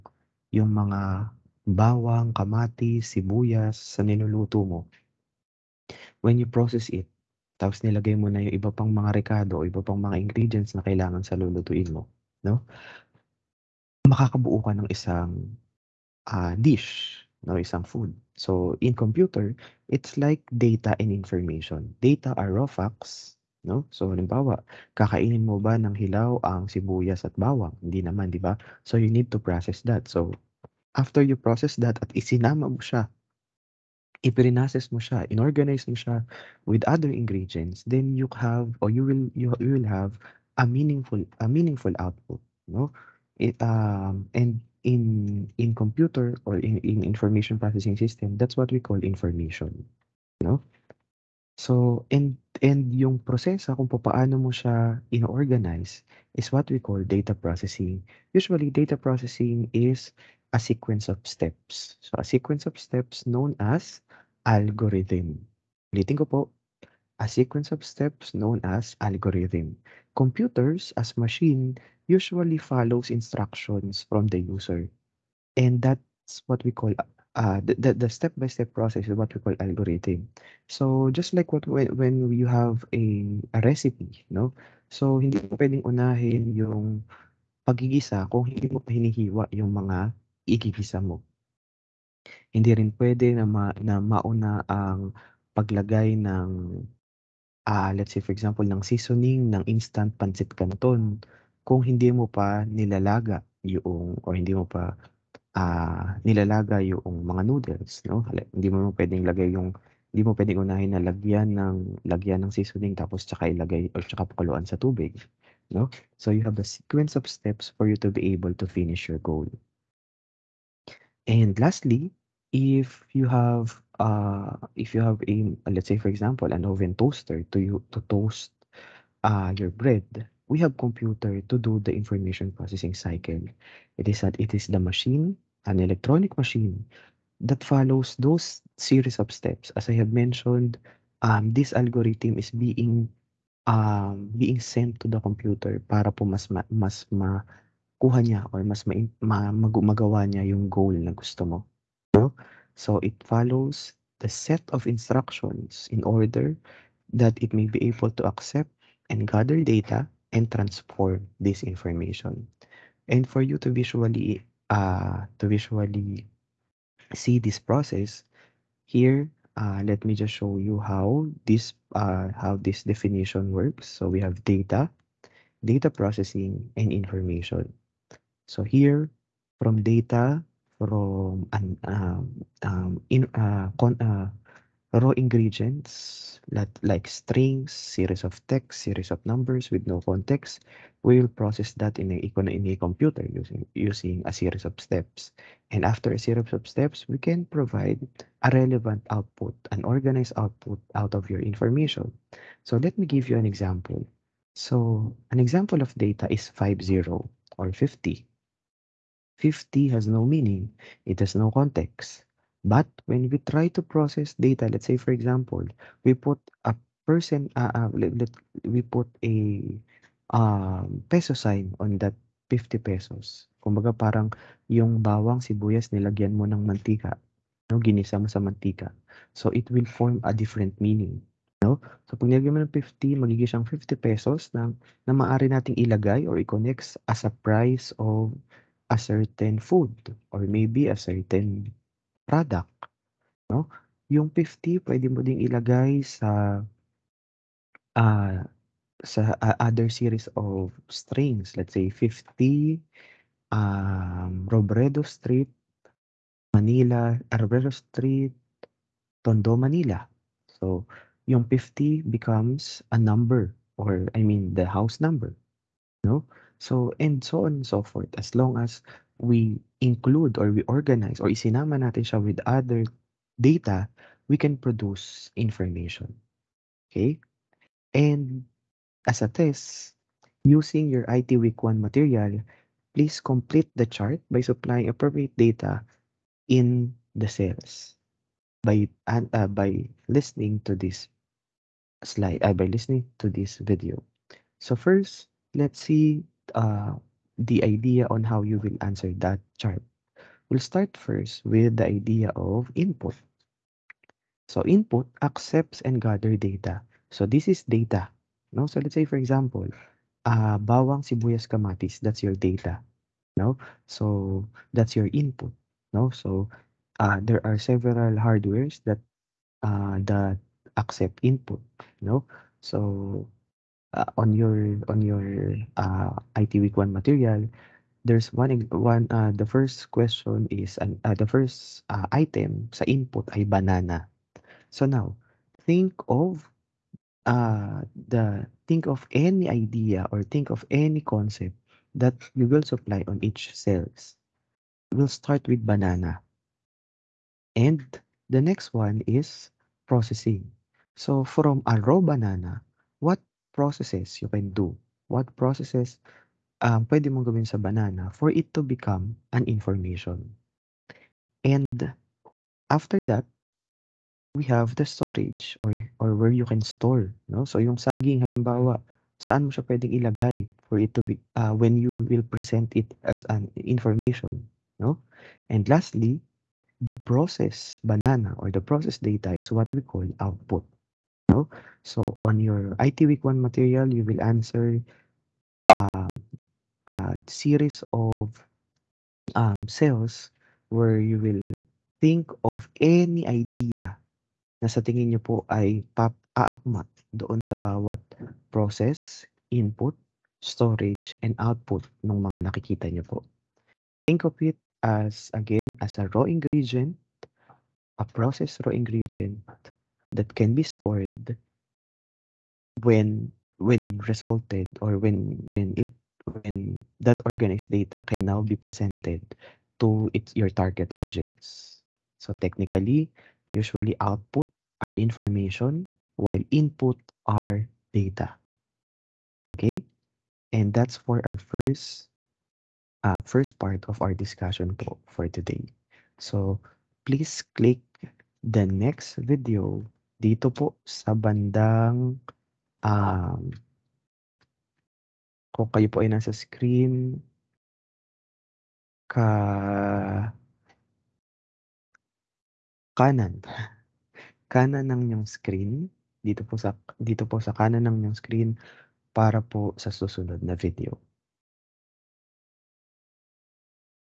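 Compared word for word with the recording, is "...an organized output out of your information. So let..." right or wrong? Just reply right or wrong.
right.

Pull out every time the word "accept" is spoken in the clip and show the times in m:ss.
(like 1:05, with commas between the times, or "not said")
2:38, 5:05, 5:20.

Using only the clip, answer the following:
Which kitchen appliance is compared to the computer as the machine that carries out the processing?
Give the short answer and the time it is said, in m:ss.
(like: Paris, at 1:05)
oven toaster, at 2:06.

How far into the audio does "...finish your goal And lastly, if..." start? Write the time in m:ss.
1:58.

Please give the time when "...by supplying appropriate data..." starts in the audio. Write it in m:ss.
4:44.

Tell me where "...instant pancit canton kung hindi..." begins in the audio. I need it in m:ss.
1:39.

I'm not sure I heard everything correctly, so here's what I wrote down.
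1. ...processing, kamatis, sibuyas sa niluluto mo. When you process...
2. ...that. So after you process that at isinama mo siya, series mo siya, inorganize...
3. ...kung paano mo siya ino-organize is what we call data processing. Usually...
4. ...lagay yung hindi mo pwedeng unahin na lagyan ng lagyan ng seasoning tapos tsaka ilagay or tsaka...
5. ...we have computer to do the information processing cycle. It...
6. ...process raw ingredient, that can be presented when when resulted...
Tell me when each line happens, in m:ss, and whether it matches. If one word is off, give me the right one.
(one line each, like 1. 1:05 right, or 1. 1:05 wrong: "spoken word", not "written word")
1. 0:01 wrong: "bawang", not "processing"
2. 0:29 wrong: "ipinases", not "series"
3. 0:53 right
4. 1:49 right
5. 2:10 right
6. 6:48 wrong: "stored", not "presented".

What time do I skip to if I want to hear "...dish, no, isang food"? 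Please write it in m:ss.
0:16.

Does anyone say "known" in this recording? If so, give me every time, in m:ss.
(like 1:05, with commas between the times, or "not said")
1:03, 1:08.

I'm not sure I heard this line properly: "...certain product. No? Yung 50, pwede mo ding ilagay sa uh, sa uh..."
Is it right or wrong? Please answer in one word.
right.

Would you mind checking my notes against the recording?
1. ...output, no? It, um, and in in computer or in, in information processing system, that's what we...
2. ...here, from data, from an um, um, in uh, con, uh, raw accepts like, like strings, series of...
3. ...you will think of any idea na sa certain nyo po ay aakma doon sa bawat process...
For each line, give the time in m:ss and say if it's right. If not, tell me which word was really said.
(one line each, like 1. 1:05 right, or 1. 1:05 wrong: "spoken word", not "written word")
1. 0:42 right
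2. 2:58 wrong: "ingredients", not "accepts"
3. 6:31 wrong: "tingin", not "certain".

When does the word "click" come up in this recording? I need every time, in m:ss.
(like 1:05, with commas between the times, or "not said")
7:17.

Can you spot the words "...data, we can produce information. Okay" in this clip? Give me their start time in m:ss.
4:33.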